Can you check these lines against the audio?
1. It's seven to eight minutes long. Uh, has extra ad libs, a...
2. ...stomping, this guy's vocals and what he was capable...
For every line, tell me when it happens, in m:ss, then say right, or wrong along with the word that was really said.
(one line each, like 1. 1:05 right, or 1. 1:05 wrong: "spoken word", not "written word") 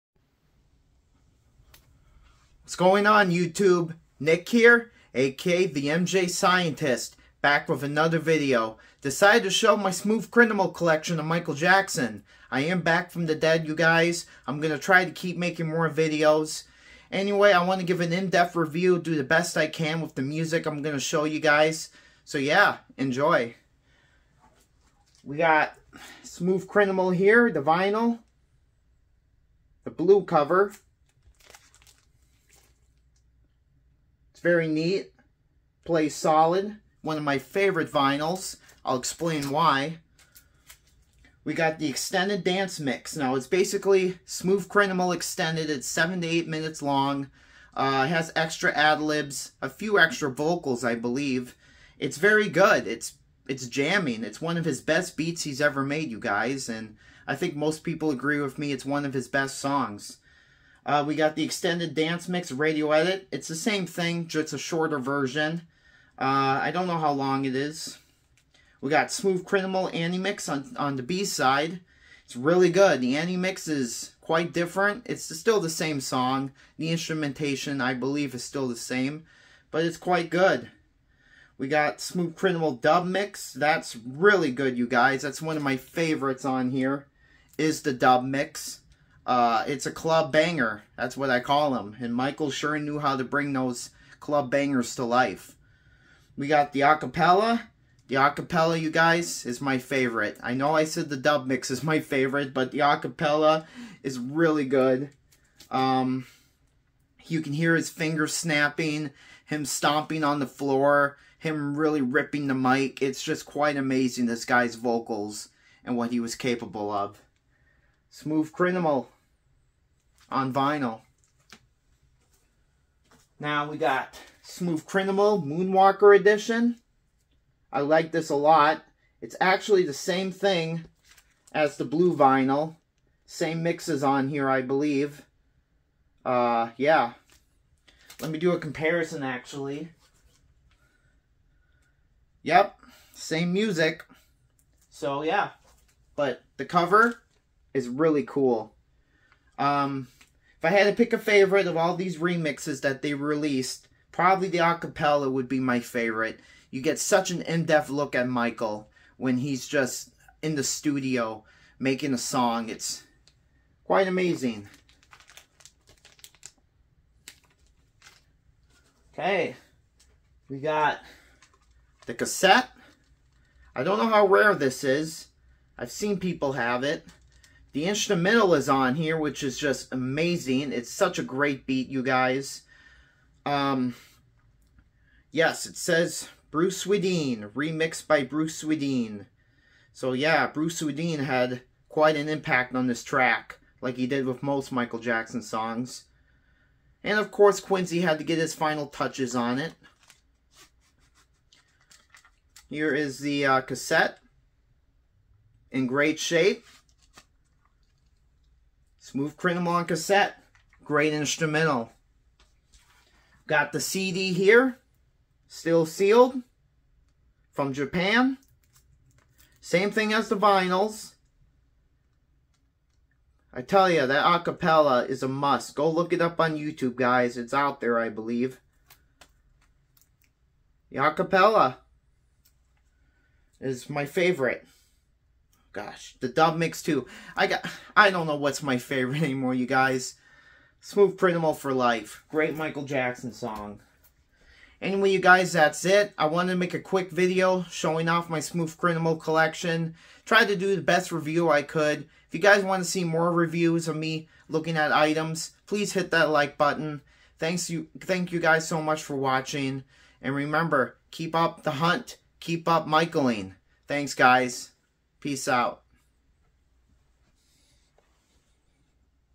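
1. 0:45 right
2. 1:53 wrong: "amazing", not "stomping".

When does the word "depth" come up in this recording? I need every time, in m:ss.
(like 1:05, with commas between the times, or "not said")
0:18, 2:37.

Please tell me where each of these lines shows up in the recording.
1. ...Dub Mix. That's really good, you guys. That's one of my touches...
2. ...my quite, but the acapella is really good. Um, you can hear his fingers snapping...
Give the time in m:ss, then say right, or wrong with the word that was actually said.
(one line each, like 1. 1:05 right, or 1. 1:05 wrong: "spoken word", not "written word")
1. 1:22 wrong: "favorites", not "touches"
2. 1:41 wrong: "favorite", not "quite".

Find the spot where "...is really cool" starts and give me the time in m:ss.
2:27.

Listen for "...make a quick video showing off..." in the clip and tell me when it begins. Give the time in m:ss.
4:06.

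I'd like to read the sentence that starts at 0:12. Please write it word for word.
I am back from the dead, you guys.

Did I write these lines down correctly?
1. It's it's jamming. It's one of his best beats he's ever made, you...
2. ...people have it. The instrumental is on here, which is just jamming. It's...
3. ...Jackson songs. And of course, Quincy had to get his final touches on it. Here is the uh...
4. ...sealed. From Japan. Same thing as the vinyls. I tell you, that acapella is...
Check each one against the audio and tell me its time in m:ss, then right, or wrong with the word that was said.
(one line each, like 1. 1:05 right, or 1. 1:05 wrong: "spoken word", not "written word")
1. 0:52 right
2. 2:56 wrong: "amazing", not "jamming"
3. 3:14 right
4. 3:35 right.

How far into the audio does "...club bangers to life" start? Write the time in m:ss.
1:34.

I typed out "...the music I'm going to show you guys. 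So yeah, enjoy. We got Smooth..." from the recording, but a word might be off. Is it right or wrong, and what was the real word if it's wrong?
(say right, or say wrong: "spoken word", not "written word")
right.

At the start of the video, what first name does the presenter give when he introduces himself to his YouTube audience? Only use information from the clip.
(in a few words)
Nick.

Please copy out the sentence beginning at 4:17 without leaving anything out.
Thanks you, Thank you guys so much for watching.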